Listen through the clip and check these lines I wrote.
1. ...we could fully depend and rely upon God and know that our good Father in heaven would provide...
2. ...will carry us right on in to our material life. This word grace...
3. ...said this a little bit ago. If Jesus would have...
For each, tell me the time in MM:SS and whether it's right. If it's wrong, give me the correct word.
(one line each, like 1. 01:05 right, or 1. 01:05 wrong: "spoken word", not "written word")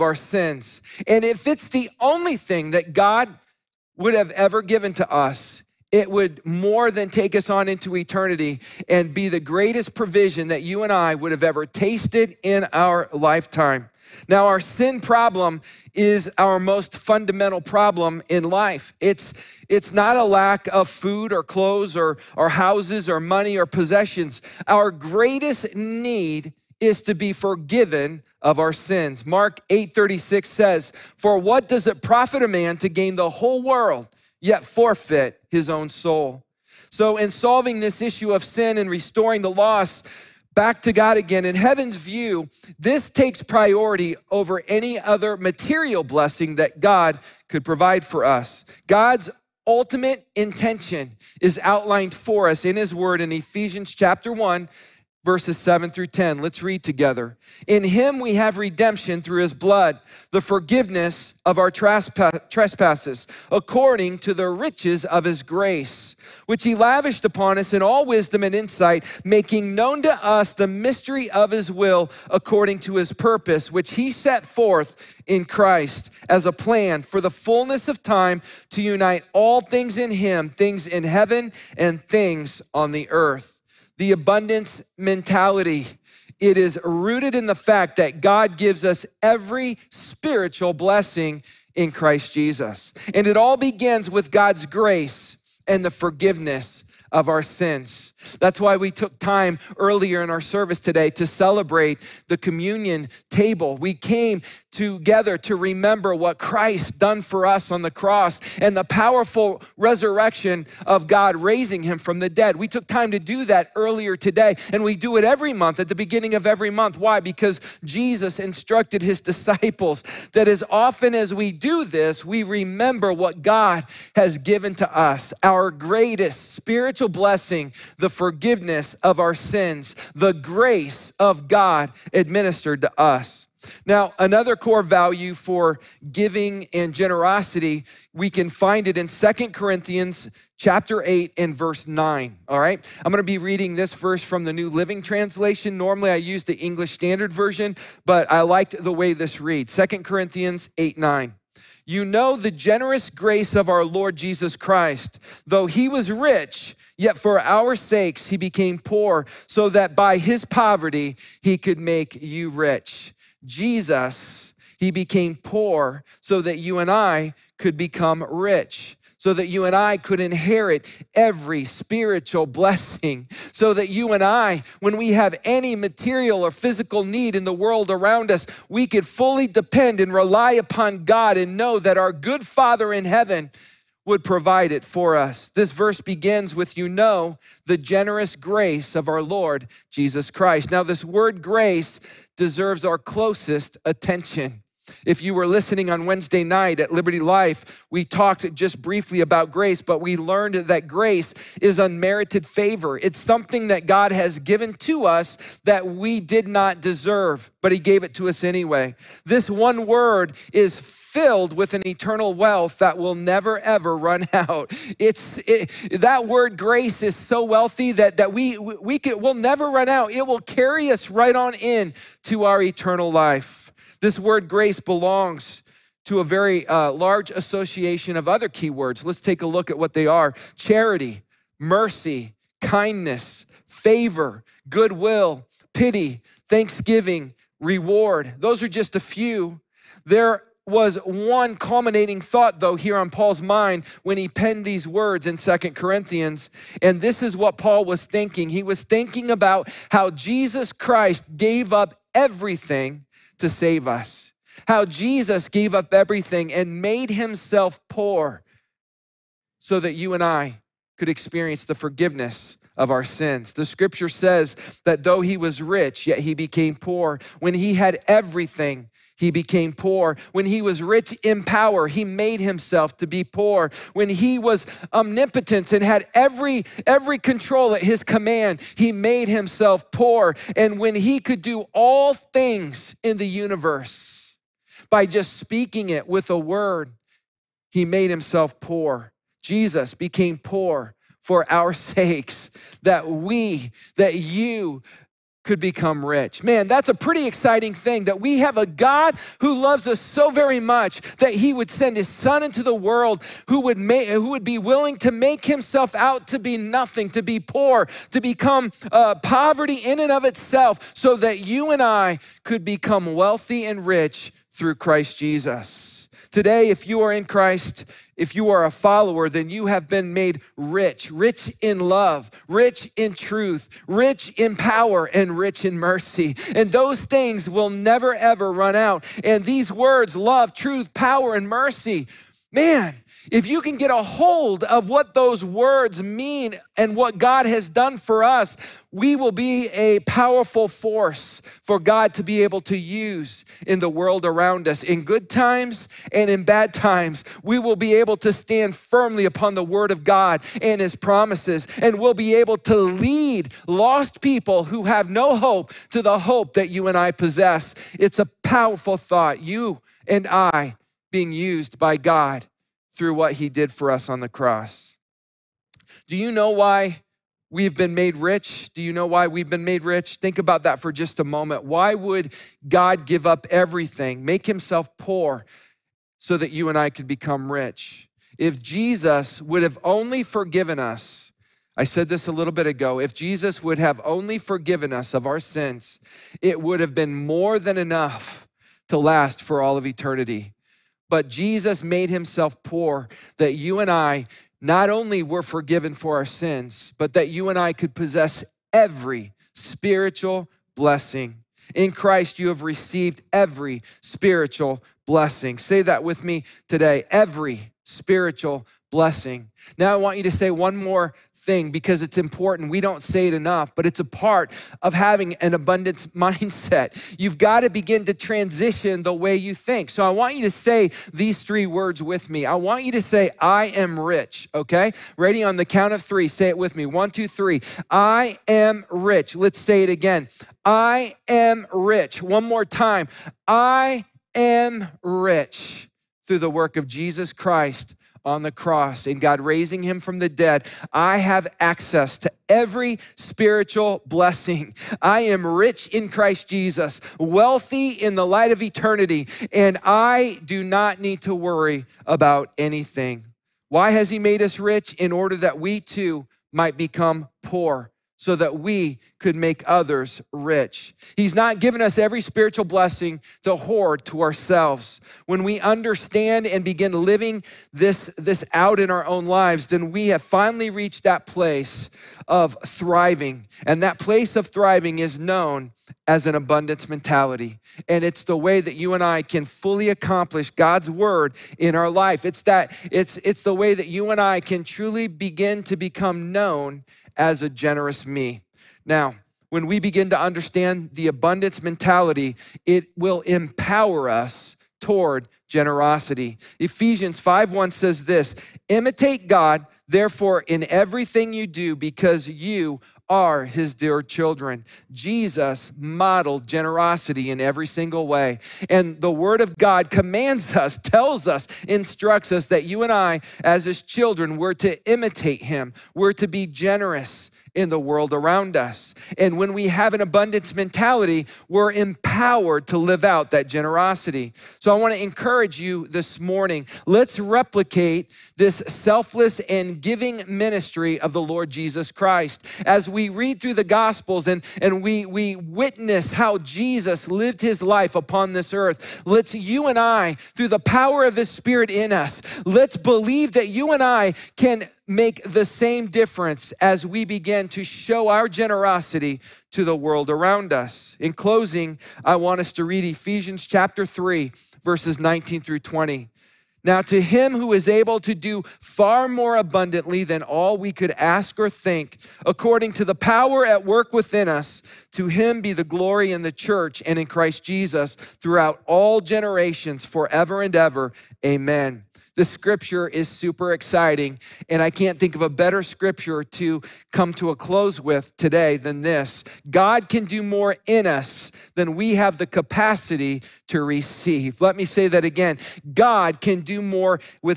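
1. 02:58 right
2. 03:40 wrong: "eternal", not "material"
3. 06:21 right.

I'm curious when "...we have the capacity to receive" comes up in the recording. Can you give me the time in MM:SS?
09:41.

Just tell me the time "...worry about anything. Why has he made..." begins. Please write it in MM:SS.
07:31.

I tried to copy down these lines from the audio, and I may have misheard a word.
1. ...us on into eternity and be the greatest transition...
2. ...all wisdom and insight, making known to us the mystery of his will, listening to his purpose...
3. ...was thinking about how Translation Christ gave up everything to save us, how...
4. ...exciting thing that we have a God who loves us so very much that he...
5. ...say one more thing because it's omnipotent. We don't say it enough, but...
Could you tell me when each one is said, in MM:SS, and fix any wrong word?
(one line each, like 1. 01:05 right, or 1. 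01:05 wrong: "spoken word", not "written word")
1. 00:07 wrong: "provision", not "transition"
2. 01:07 wrong: "according", not "listening"
3. 04:08 wrong: "Jesus", not "Translation"
4. 04:57 right
5. 06:50 wrong: "important", not "omnipotent".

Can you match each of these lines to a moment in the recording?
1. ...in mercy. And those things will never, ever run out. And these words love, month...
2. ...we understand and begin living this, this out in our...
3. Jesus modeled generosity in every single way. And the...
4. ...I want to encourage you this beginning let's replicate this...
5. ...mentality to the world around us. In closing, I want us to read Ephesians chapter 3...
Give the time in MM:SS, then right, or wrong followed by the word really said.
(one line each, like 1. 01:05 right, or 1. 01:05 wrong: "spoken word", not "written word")
1. 05:25 wrong: "truth", not "month"
2. 07:45 right
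3. 08:24 right
4. 08:44 wrong: "morning", not "beginning"
5. 09:08 wrong: "generosity", not "mentality".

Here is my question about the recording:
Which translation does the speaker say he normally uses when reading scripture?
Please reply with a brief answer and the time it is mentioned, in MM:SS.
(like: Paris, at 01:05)
English Standard Version, at 02:26.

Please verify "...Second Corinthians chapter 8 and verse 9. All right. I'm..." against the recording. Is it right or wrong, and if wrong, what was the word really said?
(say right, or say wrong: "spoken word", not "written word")
right.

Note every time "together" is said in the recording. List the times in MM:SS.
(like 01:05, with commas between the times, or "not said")
00:56, 01:44.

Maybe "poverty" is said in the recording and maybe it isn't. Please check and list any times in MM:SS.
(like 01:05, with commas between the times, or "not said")
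02:40, 05:09.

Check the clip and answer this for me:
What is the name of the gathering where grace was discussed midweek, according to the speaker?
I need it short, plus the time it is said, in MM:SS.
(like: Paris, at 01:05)
Liberty Life, at 03:16.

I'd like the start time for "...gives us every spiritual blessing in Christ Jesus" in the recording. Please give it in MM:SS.
01:28.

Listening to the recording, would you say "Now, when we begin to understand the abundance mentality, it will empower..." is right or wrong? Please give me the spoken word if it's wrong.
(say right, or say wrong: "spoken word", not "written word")
right.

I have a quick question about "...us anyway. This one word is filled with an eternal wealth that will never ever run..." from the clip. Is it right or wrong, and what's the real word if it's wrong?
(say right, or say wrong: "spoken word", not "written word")
right.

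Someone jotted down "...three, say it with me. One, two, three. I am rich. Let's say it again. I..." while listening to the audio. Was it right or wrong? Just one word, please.
right.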